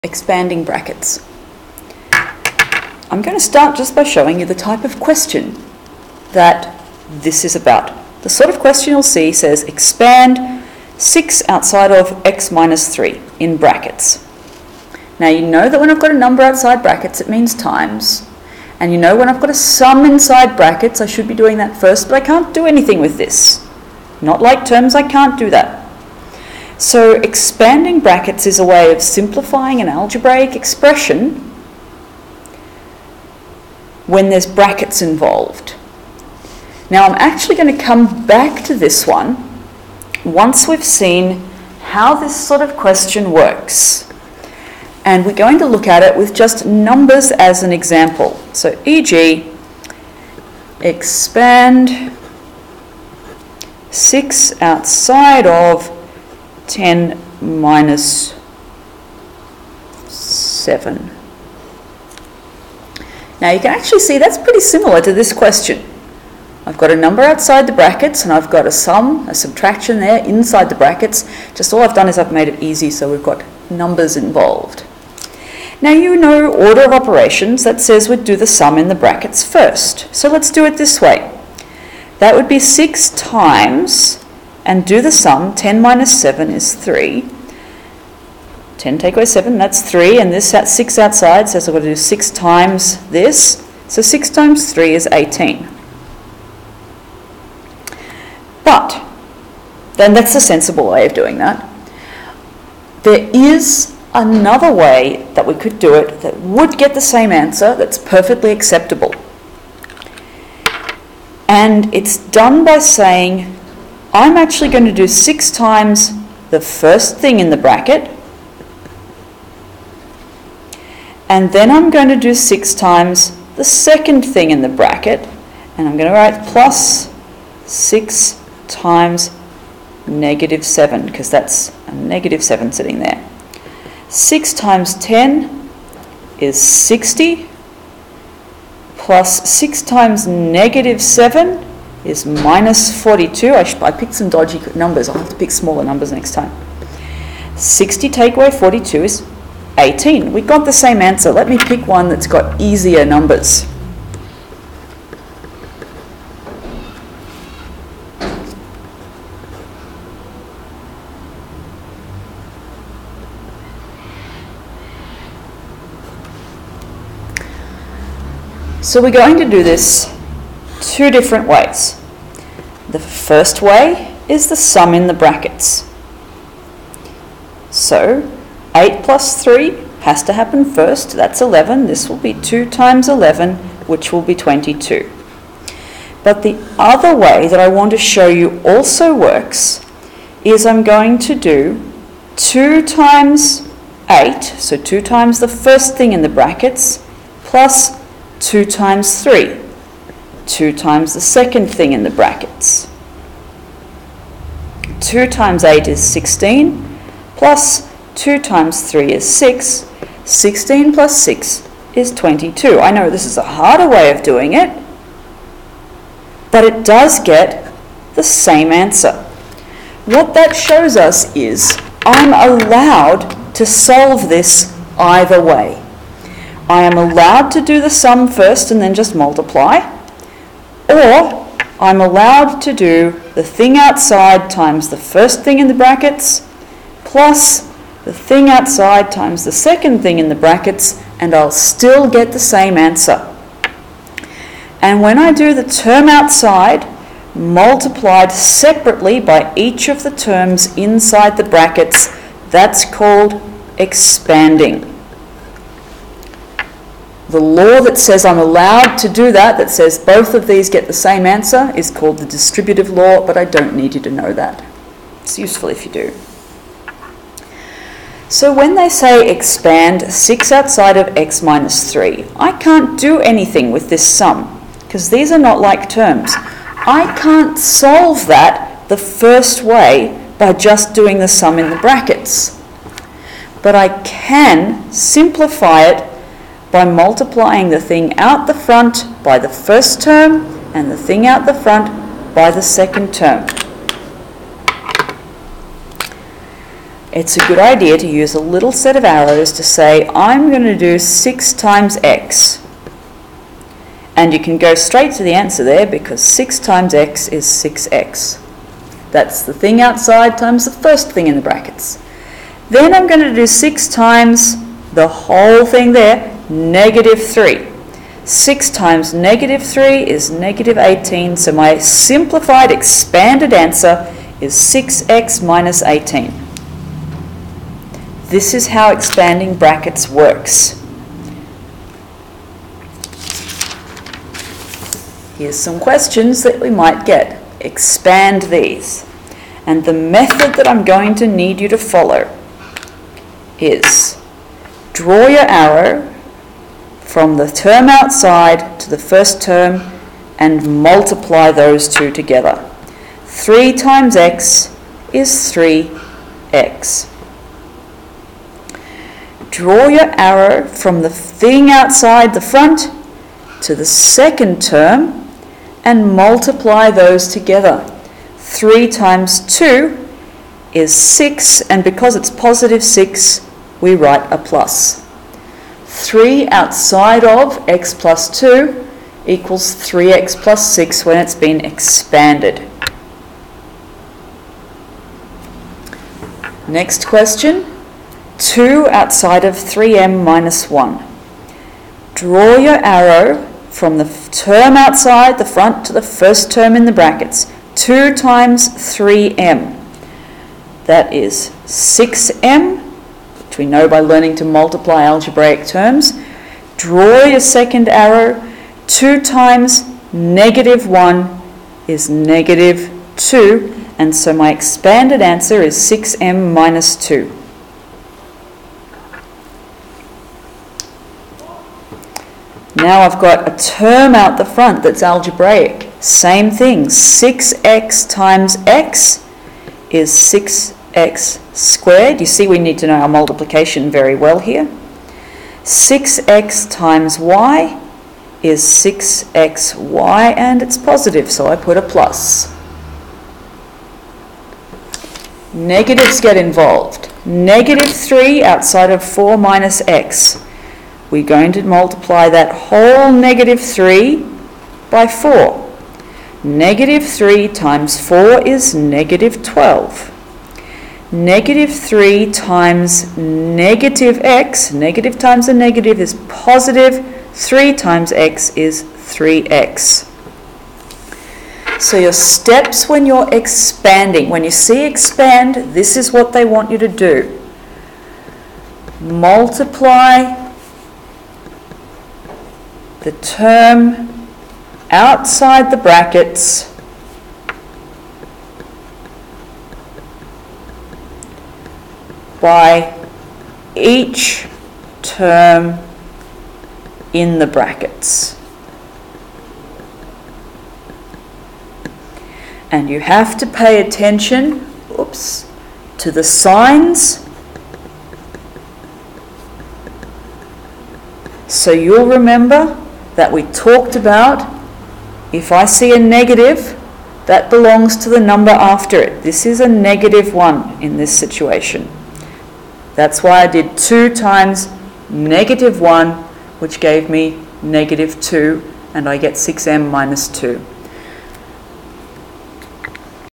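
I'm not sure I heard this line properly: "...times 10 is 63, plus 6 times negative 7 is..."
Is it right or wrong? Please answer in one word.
wrong.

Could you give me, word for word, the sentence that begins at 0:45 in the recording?
And we're going to look at it with just numbers as an example.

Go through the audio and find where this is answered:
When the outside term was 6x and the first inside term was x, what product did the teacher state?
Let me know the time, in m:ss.
7:10.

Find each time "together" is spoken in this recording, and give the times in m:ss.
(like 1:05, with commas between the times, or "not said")
5:52, 6:07.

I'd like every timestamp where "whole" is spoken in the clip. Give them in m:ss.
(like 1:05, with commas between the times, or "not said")
5:15, 7:32.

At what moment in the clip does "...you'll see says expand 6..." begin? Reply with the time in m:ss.
0:08.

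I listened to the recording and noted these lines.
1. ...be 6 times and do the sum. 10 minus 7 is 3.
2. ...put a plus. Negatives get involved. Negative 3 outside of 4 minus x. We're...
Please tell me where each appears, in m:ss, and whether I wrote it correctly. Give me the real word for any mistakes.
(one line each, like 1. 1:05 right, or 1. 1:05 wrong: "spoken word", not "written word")
1. 1:22 right
2. 7:21 right.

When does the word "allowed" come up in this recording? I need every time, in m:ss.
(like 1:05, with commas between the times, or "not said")
3:42, 3:46, 3:52, 4:18.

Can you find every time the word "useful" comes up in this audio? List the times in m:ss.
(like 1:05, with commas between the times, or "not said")
4:25.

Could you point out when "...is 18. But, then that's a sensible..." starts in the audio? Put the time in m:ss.
1:34.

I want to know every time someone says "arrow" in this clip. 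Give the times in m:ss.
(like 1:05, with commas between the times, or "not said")
4:59, 5:45, 6:00, 6:32, 6:47.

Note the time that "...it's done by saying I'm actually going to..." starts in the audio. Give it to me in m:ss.
1:51.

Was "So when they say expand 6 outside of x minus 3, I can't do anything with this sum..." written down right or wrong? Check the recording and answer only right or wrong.
right.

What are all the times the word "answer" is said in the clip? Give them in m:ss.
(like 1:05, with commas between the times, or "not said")
1:47, 2:31, 3:38, 4:02, 4:21, 5:05, 5:23, 6:55.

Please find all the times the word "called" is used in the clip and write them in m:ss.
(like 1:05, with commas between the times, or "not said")
4:12, 4:21.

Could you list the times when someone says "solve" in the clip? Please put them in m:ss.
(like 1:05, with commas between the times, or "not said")
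3:43, 4:37.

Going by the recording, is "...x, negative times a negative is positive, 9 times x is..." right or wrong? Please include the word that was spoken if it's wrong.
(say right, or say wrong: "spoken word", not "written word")
wrong: "3", not "9".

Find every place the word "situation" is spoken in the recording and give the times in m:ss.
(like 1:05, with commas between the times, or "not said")
8:41.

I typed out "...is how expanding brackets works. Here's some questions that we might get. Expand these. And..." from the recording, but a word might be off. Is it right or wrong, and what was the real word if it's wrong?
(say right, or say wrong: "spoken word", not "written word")
right.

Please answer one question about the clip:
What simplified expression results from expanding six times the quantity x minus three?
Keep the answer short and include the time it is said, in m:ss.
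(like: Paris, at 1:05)
6x minus 18, at 5:24.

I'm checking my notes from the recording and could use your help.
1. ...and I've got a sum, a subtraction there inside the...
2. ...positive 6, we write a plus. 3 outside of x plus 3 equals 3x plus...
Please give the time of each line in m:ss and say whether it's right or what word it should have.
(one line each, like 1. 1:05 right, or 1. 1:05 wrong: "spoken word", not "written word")
1. 1:08 right
2. 6:12 wrong: "2", not "3".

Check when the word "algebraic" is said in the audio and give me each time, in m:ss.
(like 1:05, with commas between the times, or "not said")
0:29, 6:45, 7:05.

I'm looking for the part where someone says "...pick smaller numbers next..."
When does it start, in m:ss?
2:25.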